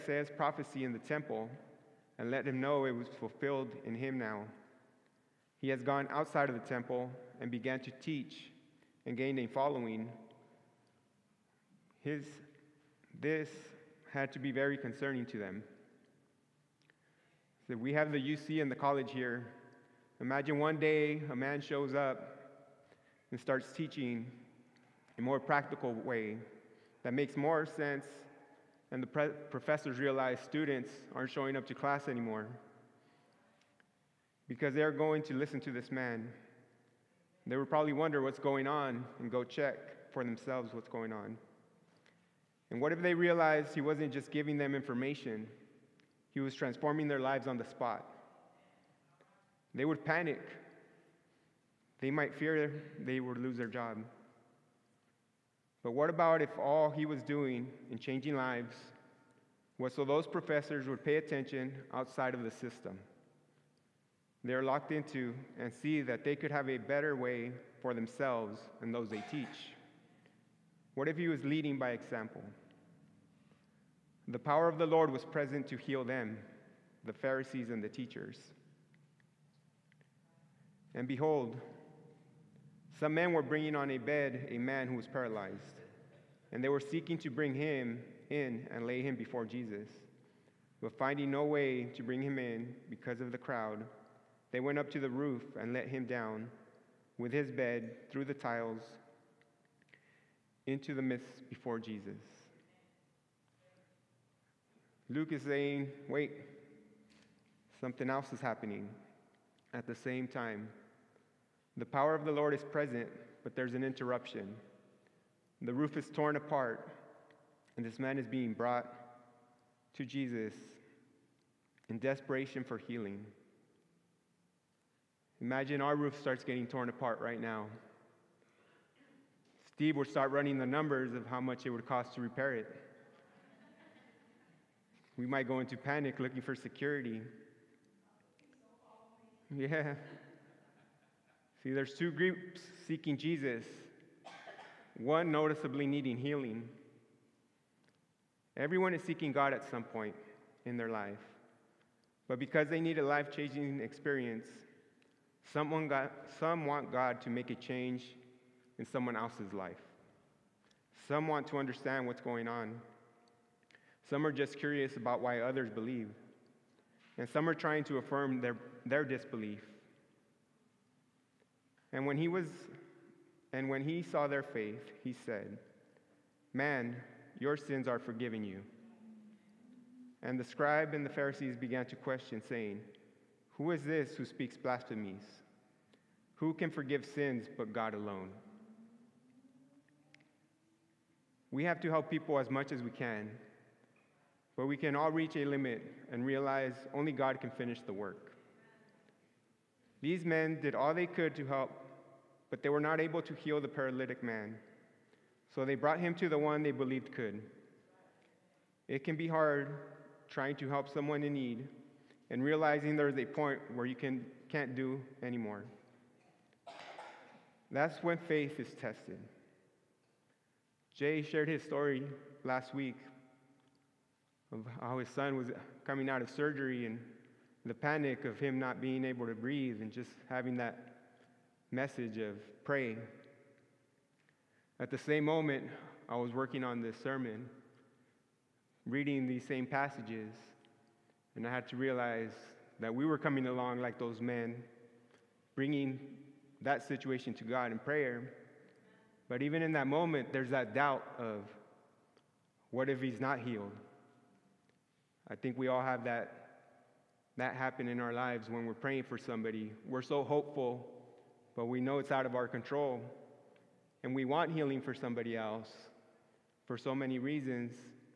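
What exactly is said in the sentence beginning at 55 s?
But what about if all he was doing in changing lives was so those professors would pay attention outside of the system?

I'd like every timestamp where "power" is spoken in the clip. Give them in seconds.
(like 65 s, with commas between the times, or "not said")
74 s, 111 s.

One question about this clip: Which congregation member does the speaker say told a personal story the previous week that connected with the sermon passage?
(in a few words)
Jay.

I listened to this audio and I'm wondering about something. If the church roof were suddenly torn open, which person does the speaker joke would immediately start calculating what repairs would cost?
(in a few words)
Steve.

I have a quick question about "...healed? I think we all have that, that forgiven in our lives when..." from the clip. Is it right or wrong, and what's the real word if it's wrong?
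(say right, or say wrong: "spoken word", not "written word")
wrong: "happen", not "forgiven".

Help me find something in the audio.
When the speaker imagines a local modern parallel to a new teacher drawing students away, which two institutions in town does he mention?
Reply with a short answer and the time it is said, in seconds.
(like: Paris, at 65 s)
UC and the college, at 18 s.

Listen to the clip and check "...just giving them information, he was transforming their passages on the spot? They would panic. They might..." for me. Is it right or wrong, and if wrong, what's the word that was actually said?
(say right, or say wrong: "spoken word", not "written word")
wrong: "lives", not "passages".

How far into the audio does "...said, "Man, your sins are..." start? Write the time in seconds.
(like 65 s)
175 s.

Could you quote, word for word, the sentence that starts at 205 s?
So they brought him to the one they believed could.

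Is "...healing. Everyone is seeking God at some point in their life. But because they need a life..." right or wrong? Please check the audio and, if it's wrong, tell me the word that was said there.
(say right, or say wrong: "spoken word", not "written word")
right.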